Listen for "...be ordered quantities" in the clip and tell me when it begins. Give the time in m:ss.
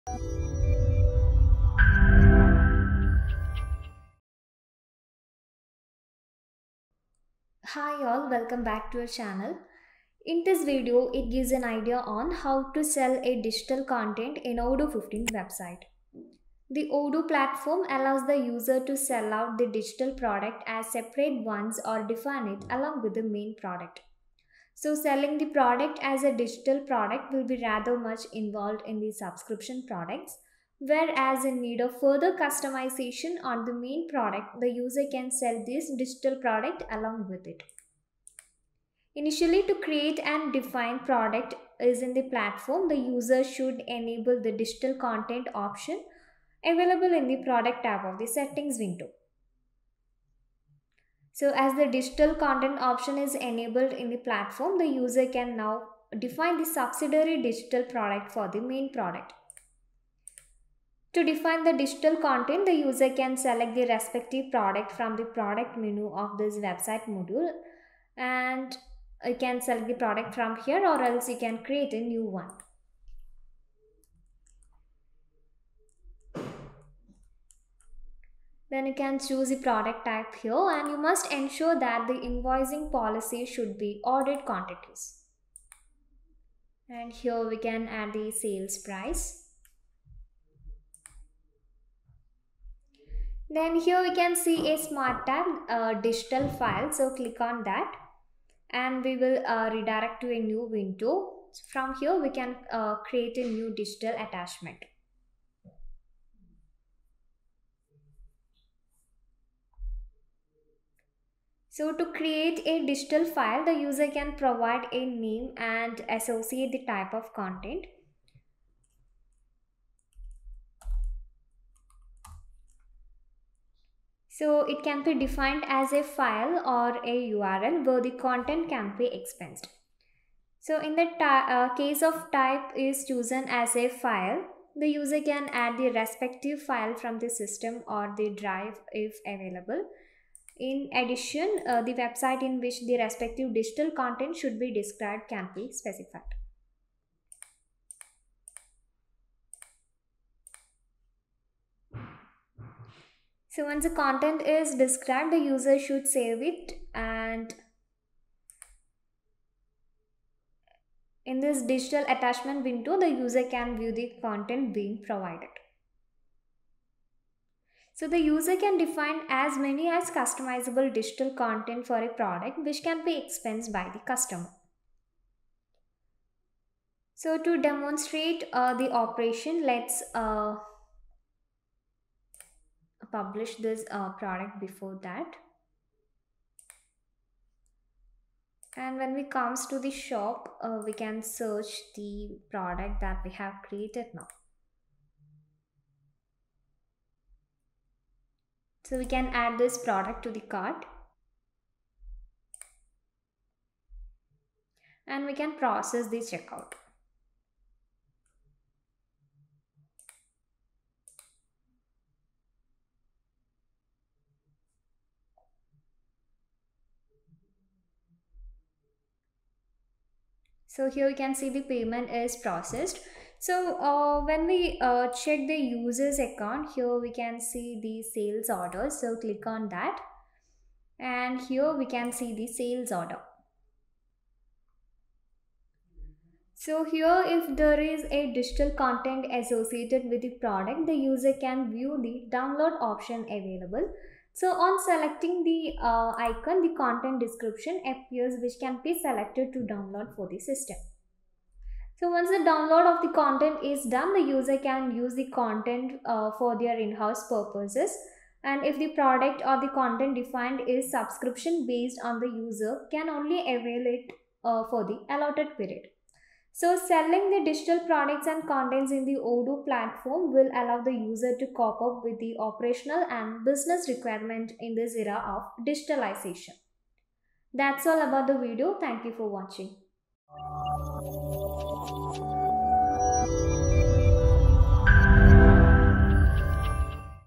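1:23.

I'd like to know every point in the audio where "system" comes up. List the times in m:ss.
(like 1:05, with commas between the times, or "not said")
2:17, 4:10.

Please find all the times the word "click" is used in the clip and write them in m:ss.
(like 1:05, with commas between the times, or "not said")
1:37, 3:49.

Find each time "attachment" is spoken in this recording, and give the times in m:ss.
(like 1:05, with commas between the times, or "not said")
1:44, 2:42.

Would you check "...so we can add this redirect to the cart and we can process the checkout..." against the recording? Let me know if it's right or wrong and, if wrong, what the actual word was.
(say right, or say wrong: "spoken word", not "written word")
wrong: "product", not "redirect".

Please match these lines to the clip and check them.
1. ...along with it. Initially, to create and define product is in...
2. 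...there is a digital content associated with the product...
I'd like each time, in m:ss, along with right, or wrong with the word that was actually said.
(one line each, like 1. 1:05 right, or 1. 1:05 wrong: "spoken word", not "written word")
1. 0:36 right
2. 3:57 right.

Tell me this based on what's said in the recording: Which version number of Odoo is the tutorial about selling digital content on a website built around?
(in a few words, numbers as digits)
15.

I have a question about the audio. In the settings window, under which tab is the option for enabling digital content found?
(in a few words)
product tab.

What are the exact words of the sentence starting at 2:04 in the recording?
So it can be defined as a file or a URL where the content can be expensed.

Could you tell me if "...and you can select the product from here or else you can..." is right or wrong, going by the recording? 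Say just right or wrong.
right.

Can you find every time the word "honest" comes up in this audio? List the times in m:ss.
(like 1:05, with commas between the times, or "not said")
not said.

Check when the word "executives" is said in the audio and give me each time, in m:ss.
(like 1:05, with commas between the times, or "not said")
not said.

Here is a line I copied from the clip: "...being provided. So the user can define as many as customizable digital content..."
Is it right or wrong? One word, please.
right.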